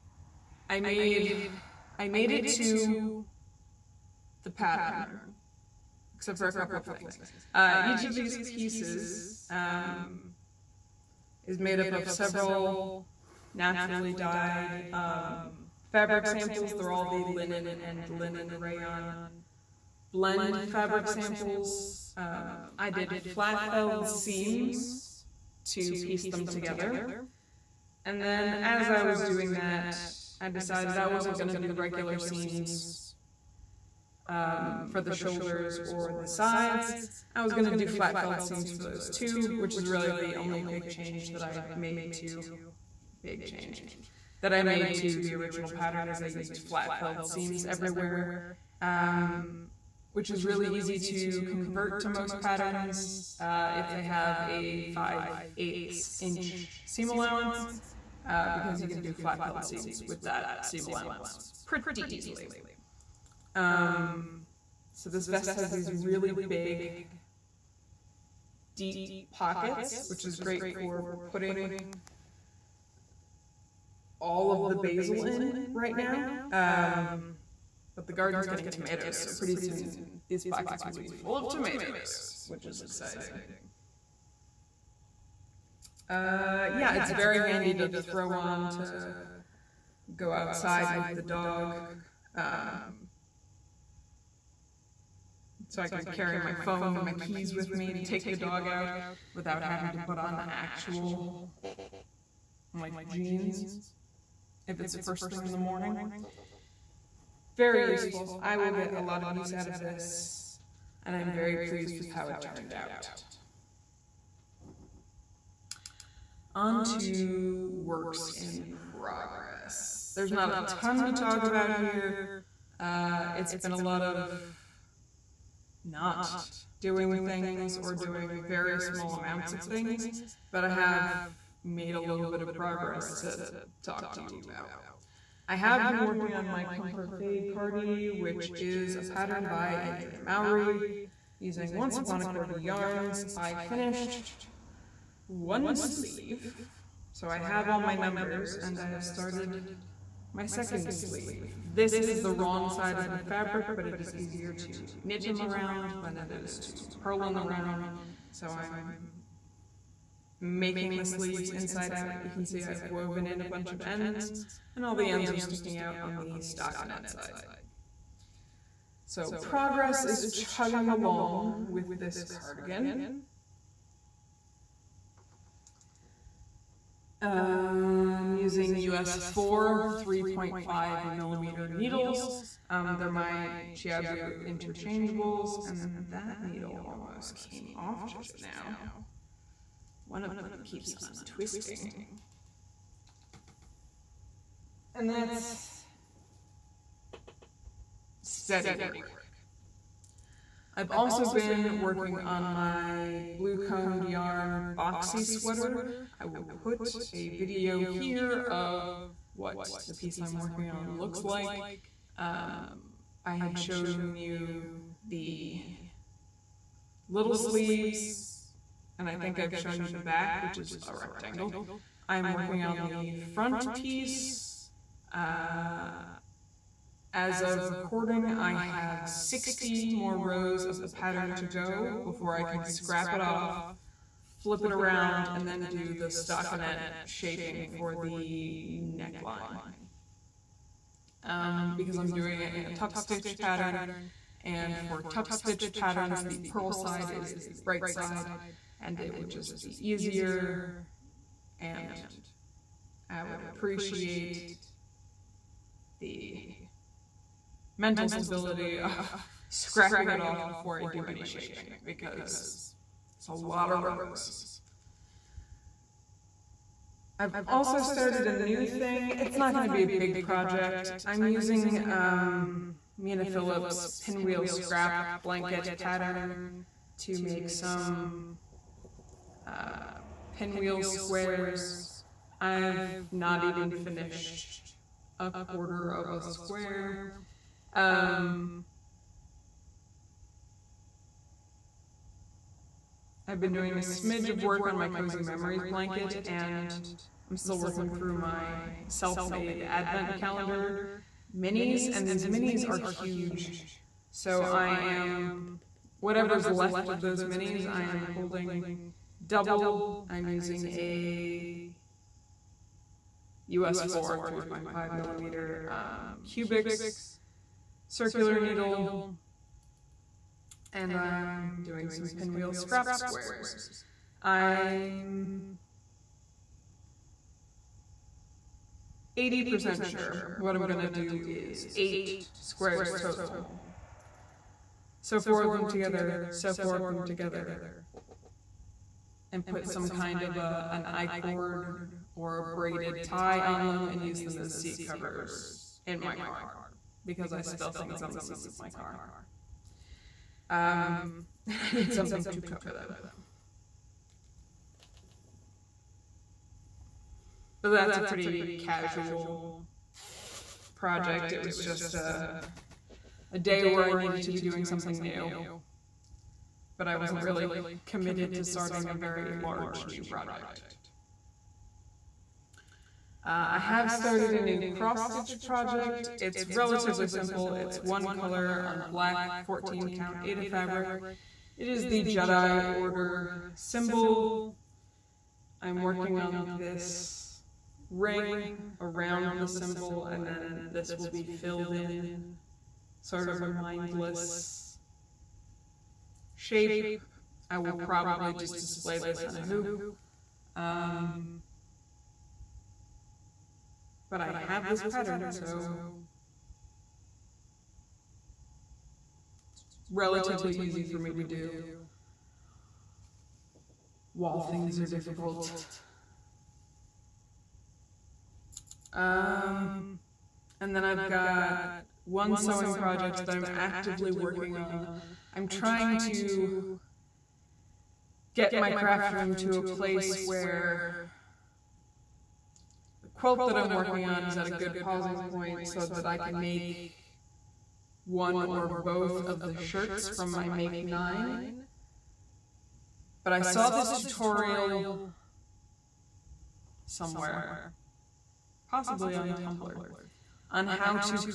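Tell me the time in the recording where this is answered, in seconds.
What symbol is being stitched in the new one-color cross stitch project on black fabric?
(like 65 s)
382 s.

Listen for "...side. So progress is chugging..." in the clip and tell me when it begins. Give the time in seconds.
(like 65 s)
167 s.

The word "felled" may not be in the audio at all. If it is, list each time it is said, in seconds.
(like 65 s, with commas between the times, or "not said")
23 s, 38 s, 46 s, 59 s.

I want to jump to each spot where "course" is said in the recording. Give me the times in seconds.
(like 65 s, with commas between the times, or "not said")
not said.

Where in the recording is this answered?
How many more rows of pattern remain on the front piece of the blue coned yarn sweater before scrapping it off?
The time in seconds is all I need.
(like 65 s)
229 s.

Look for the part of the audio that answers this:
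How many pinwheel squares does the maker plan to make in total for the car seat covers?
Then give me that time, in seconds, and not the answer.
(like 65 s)
331 s.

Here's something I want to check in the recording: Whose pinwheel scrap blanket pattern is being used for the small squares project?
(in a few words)
Mina Phillips.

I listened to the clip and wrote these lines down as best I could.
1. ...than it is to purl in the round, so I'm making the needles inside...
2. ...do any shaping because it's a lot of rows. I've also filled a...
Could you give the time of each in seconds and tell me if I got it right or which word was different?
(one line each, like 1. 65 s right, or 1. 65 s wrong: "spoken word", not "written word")
1. 156 s wrong: "sleeves", not "needles"
2. 260 s wrong: "started", not "filled".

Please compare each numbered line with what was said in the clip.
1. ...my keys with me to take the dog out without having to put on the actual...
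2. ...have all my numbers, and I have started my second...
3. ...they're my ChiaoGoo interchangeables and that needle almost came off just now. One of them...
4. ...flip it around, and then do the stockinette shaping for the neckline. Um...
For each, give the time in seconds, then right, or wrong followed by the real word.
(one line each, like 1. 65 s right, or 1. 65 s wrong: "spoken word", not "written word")
1. 97 s right
2. 147 s right
3. 182 s right
4. 234 s right.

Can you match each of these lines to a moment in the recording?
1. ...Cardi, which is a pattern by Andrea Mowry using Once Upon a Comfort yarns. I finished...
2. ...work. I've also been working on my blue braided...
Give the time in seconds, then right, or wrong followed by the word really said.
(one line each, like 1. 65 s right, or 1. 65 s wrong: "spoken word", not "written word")
1. 137 s wrong: "Corgi", not "Comfort"
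2. 198 s wrong: "coned", not "braided".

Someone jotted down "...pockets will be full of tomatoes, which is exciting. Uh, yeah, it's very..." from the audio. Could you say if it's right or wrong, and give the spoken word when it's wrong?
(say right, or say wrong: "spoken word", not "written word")
right.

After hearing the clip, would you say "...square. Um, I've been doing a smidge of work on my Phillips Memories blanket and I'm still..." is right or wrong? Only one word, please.
wrong.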